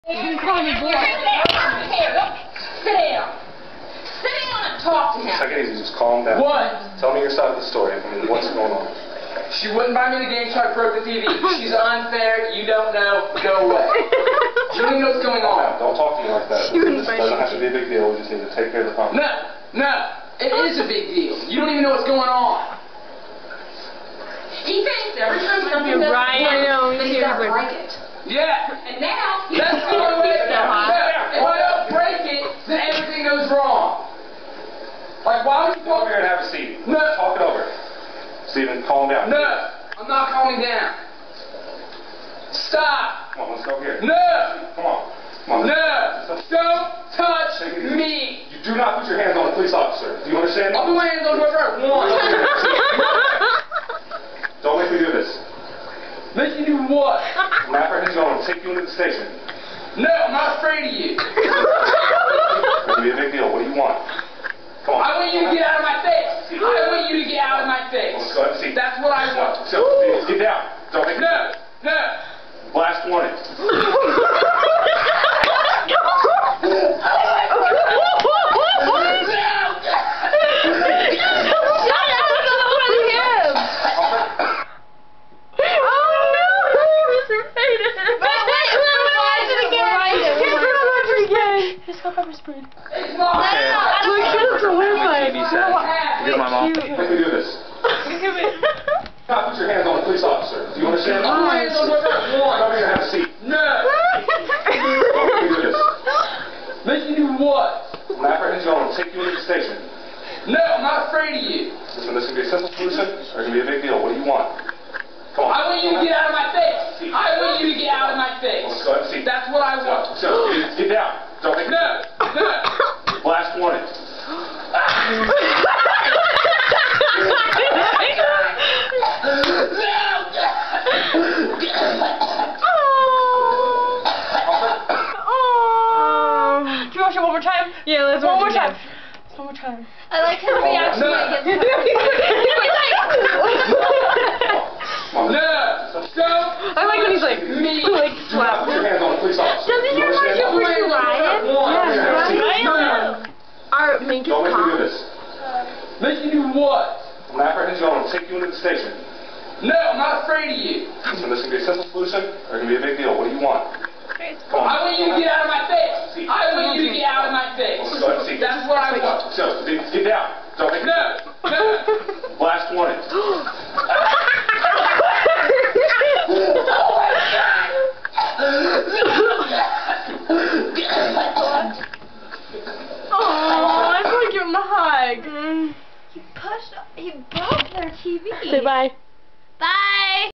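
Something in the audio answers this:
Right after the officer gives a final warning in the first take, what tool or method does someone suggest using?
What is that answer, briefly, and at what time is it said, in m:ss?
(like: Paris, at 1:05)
pepper spray, at 1:32.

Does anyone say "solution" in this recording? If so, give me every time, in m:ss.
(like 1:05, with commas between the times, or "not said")
1:52, 2:41.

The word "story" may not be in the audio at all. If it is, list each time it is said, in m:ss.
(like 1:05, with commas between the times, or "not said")
0:07.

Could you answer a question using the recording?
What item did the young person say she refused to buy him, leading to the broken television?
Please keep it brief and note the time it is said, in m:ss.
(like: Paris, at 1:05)
the game, at 0:10.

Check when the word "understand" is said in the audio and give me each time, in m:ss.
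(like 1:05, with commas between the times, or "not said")
0:50, 1:40.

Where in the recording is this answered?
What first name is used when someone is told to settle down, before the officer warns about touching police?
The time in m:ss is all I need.
0:38.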